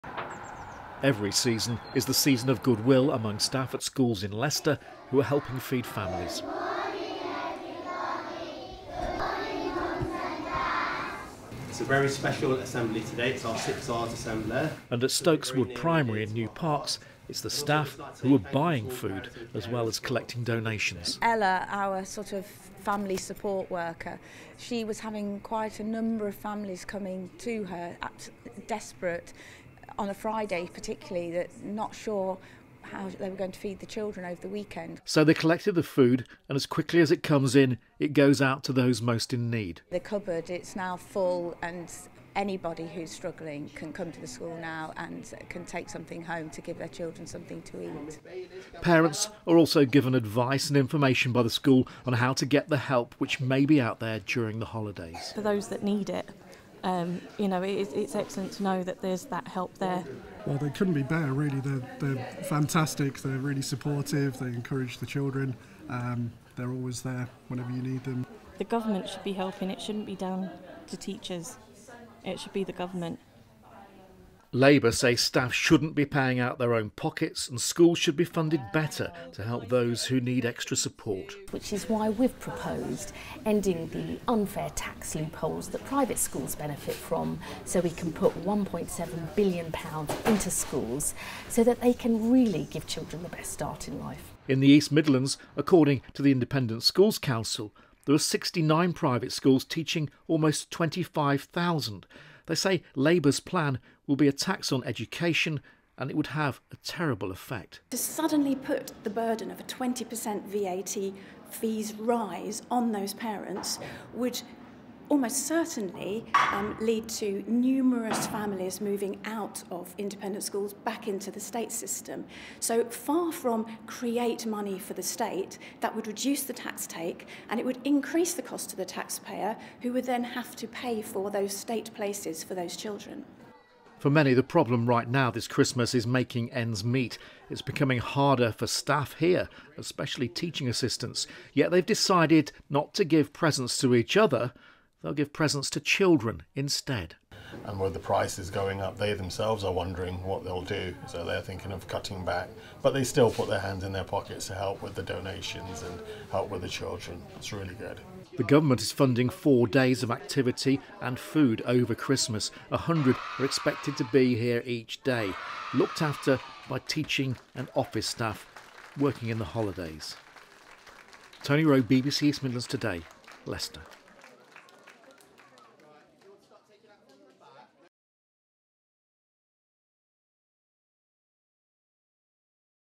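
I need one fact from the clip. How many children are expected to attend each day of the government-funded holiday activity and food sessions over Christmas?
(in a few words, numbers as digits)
100.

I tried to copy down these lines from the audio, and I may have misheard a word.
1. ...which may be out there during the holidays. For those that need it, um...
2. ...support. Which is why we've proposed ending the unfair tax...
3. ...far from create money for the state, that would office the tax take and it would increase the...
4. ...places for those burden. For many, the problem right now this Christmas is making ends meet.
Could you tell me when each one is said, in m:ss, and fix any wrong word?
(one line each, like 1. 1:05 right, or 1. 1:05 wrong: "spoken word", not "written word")
1. 0:53 right
2. 1:20 right
3. 2:02 wrong: "reduce", not "office"
4. 2:11 wrong: "children", not "burden".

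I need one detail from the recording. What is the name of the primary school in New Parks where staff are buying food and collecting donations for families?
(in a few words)
Stokes Wood Primary.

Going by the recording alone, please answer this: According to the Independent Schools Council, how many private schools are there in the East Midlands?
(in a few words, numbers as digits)
69.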